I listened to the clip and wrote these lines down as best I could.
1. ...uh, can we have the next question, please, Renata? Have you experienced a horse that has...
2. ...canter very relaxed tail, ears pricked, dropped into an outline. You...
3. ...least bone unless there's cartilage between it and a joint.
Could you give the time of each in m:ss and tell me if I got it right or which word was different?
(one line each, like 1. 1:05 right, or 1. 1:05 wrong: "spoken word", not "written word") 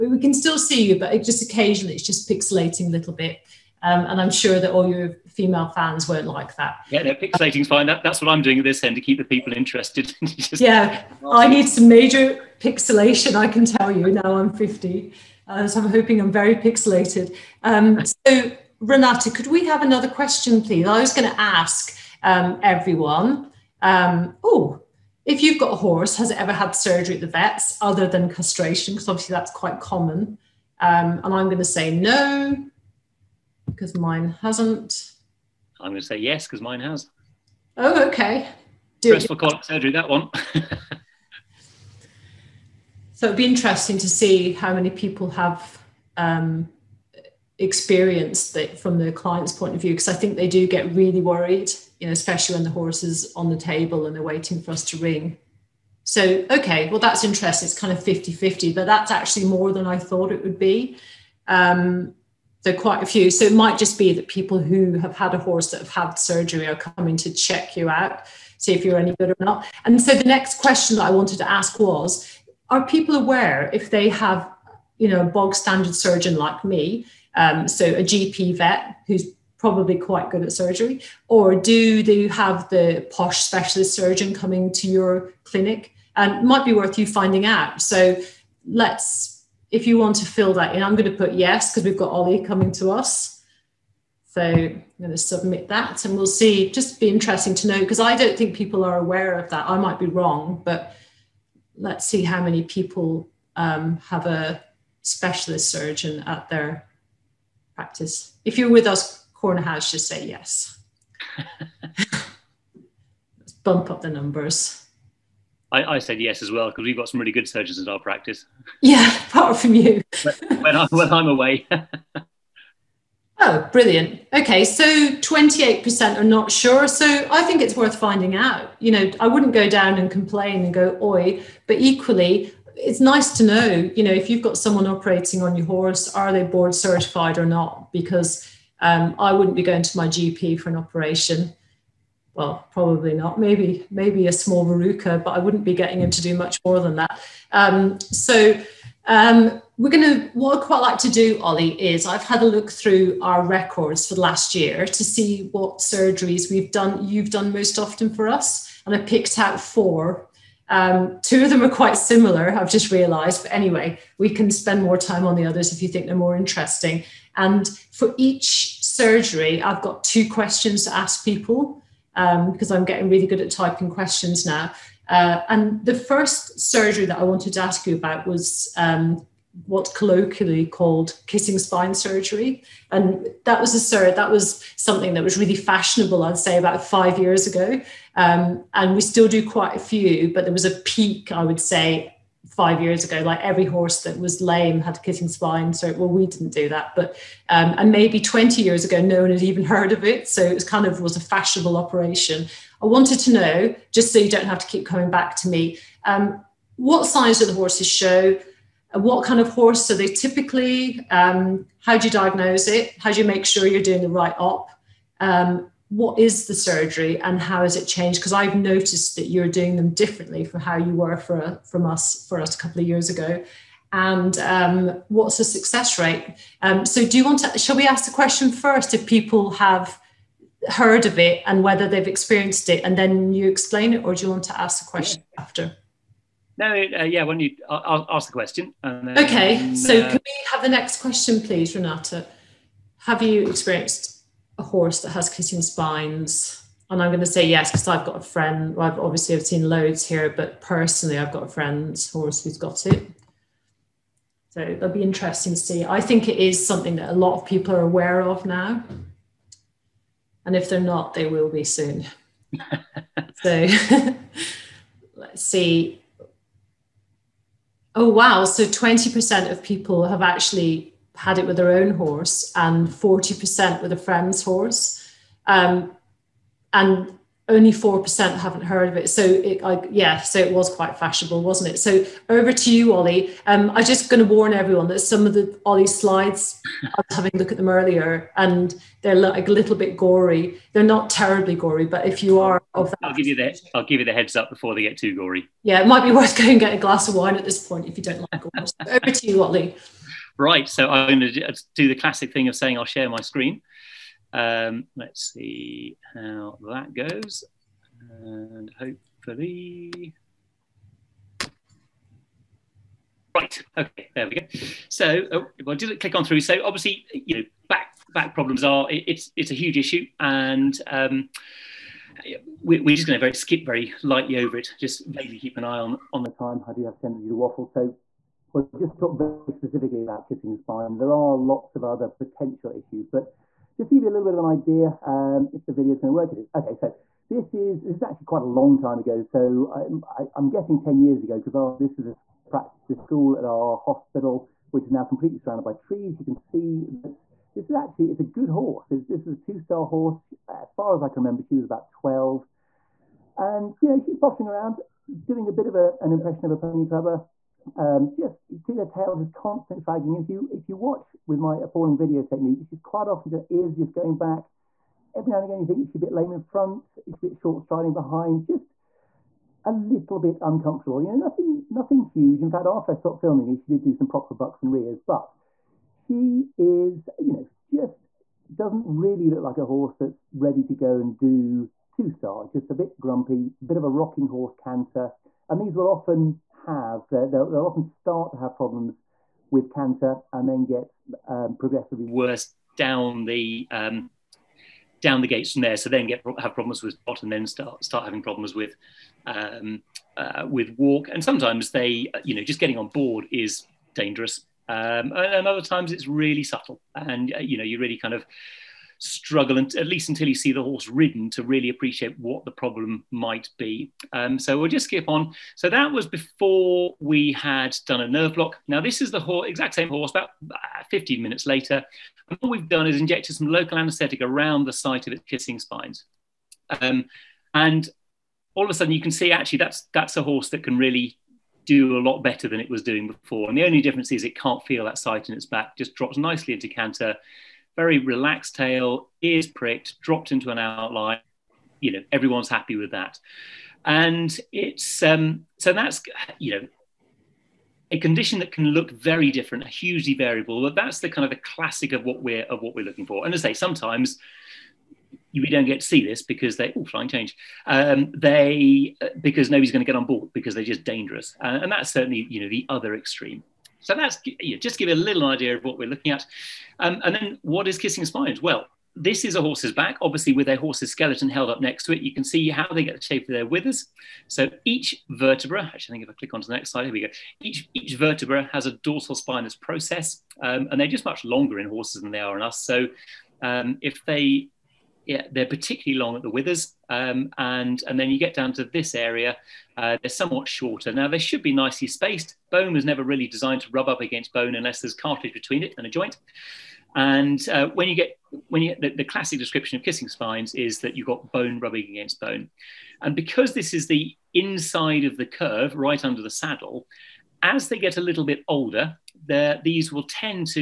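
1. 4:00 right
2. 7:16 right
3. 8:14 wrong: "against", not "least".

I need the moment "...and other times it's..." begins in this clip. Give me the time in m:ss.
6:45.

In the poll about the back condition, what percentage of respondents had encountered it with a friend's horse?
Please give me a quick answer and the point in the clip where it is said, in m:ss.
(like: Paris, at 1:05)
40%, at 4:32.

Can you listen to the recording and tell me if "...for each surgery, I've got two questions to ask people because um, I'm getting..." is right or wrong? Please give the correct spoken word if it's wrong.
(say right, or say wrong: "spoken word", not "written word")
right.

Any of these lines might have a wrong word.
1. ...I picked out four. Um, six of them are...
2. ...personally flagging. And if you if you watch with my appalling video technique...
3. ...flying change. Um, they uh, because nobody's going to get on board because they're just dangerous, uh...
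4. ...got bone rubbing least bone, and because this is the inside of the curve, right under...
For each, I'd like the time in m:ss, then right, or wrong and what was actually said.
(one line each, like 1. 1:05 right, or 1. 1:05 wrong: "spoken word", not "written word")
1. 2:38 wrong: "two", not "six"
2. 5:59 wrong: "constantly", not "personally"
3. 7:36 right
4. 8:21 wrong: "against", not "least".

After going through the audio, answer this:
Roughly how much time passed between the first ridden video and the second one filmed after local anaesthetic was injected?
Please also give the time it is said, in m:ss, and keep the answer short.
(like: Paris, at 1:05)
15 minutes, at 7:00.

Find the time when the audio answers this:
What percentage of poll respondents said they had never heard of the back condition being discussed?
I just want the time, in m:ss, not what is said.
4:37.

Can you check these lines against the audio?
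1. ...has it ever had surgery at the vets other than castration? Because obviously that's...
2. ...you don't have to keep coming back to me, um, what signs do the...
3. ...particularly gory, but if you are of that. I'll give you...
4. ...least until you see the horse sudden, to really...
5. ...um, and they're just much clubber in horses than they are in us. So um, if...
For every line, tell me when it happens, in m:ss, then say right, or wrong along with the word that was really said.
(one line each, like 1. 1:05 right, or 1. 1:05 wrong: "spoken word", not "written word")
1. 0:26 right
2. 3:24 right
3. 4:51 wrong: "terribly", not "particularly"
4. 6:49 wrong: "ridden", not "sudden"
5. 8:00 wrong: "longer", not "clubber".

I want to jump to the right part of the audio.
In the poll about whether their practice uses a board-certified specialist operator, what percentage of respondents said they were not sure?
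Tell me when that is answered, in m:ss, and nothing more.
2:04.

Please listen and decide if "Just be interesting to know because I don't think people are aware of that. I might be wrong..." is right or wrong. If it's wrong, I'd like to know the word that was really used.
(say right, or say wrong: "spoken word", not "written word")
right.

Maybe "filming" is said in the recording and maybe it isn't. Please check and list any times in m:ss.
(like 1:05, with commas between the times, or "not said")
6:13.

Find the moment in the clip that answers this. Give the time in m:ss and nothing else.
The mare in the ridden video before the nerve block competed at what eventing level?
5:49.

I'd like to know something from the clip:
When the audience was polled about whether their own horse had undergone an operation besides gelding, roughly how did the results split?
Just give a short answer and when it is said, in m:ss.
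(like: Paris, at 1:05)
50 50, at 0:58.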